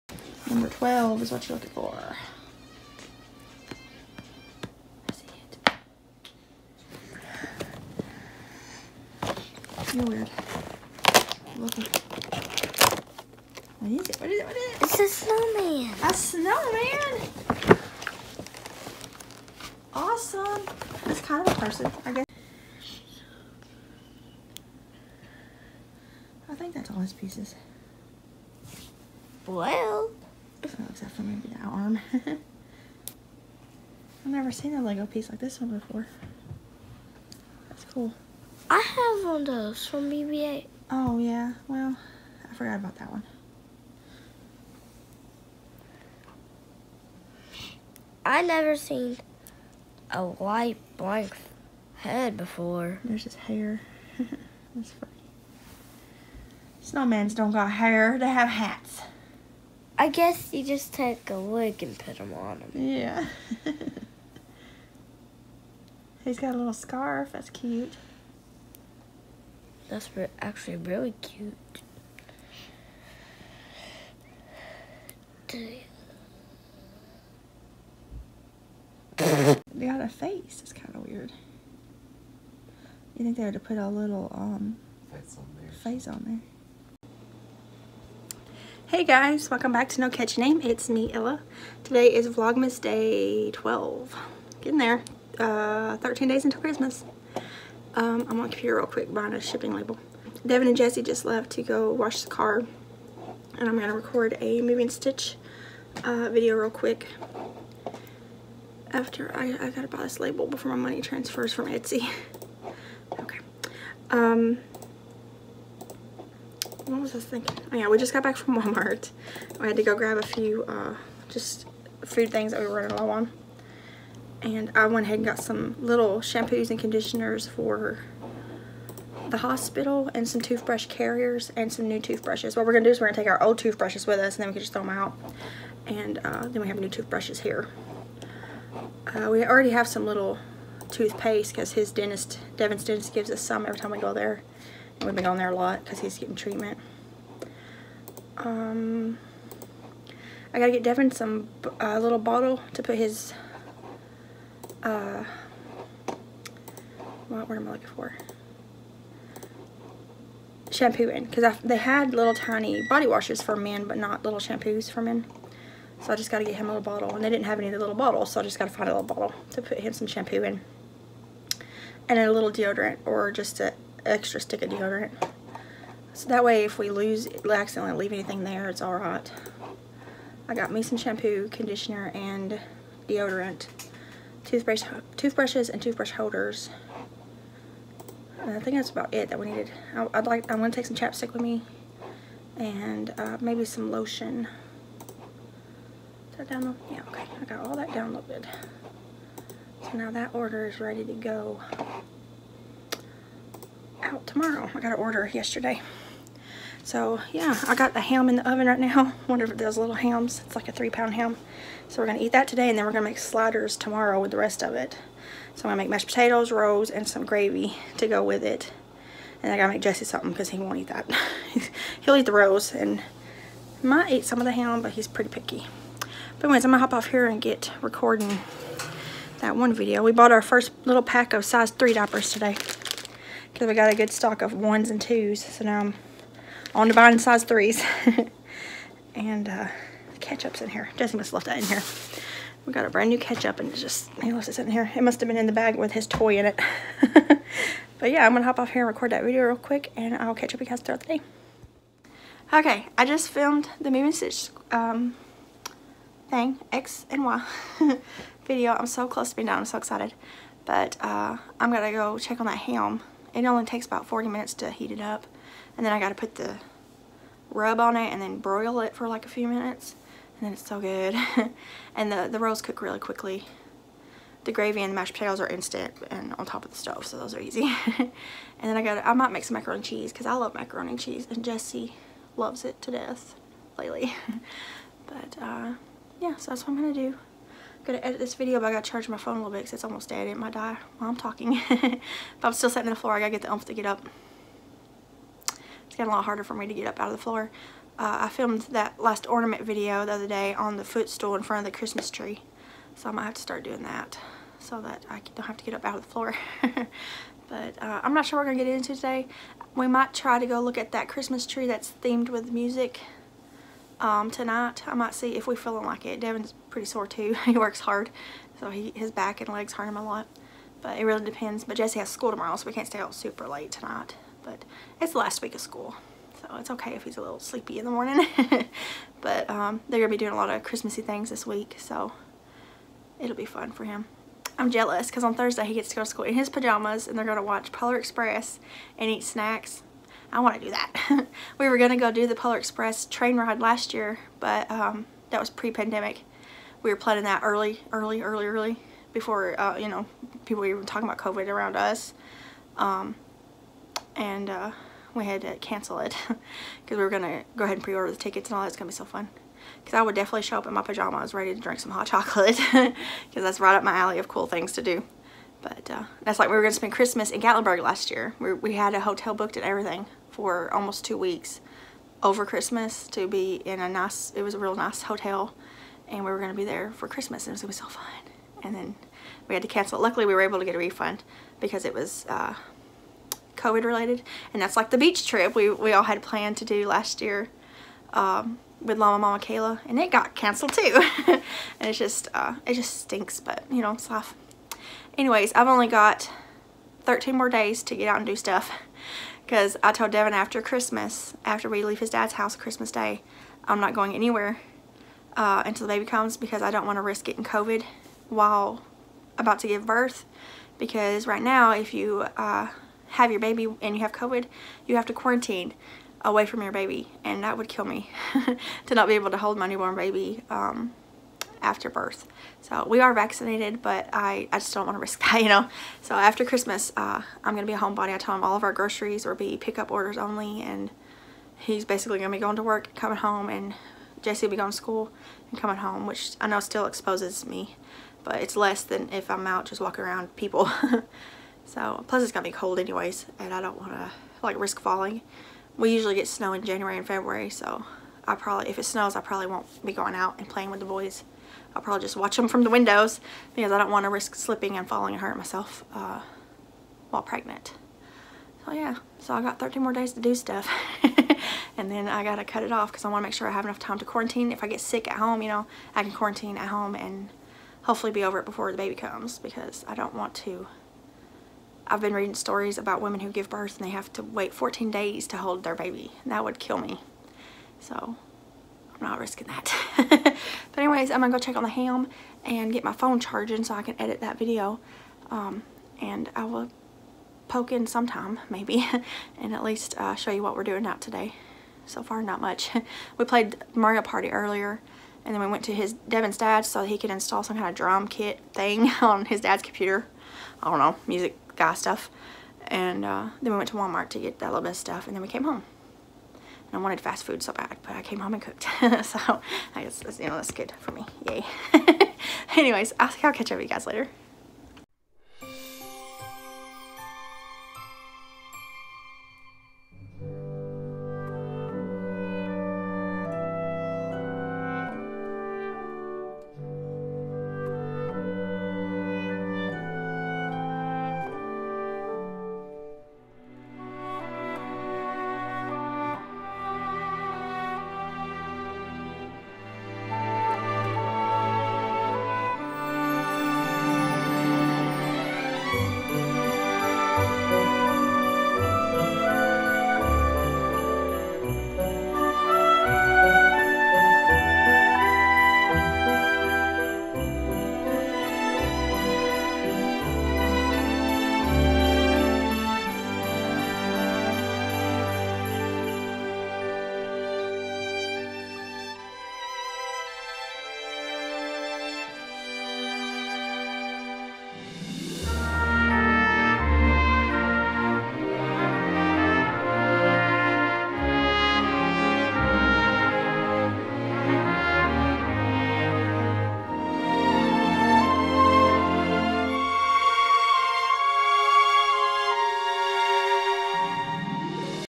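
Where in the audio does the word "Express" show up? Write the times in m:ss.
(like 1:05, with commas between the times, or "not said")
5:37, 5:42.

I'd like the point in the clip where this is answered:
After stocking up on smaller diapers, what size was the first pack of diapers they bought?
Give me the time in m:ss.
3:51.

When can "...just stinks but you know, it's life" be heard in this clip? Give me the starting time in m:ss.
6:32.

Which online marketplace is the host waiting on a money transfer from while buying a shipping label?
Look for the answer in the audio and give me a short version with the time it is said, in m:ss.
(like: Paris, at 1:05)
Etsy, at 1:51.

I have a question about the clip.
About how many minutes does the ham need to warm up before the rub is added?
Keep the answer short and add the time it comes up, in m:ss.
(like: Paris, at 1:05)
40, at 4:24.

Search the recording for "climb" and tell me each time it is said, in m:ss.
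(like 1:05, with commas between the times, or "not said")
not said.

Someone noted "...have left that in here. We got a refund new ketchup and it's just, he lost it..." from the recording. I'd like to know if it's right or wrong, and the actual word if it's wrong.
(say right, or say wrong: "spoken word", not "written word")
wrong: "brand", not "refund".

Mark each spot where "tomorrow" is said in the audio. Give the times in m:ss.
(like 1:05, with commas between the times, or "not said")
3:24, 3:33, 5:22.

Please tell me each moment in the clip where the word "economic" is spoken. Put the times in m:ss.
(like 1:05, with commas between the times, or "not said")
not said.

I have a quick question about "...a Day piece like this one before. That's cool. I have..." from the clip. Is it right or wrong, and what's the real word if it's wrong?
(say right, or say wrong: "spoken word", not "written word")
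wrong: "Lego", not "Day".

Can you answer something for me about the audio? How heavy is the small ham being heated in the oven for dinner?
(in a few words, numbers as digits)
3 pounds.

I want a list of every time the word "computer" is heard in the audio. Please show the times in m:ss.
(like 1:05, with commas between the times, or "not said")
1:38, 8:19.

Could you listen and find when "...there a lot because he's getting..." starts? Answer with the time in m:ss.
2:25.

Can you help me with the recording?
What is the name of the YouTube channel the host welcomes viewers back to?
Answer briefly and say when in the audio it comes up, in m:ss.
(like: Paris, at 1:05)
No Catchy Name, at 1:30.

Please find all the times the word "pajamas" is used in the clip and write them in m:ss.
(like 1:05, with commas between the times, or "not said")
5:36, 6:00.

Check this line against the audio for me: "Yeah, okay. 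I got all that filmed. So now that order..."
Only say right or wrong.
wrong.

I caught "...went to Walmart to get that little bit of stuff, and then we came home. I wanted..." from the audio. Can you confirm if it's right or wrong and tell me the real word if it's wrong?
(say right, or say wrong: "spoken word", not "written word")
right.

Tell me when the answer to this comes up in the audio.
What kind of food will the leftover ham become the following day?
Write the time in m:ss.
3:33.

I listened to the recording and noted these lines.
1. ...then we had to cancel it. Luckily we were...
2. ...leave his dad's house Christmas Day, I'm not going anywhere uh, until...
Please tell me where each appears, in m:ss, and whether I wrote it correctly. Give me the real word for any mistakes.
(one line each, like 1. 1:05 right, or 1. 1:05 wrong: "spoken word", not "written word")
1. 6:18 right
2. 6:41 right.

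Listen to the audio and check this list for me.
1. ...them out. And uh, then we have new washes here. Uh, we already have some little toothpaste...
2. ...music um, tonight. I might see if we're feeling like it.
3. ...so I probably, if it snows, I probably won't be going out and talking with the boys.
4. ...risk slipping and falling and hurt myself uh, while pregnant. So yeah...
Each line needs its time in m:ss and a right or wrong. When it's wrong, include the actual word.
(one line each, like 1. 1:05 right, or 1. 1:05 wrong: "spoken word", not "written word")
1. 2:14 wrong: "toothbrushes", not "washes"
2. 5:12 right
3. 7:27 wrong: "playing", not "talking"
4. 7:34 right.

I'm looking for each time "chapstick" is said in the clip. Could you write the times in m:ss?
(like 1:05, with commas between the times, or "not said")
3:10.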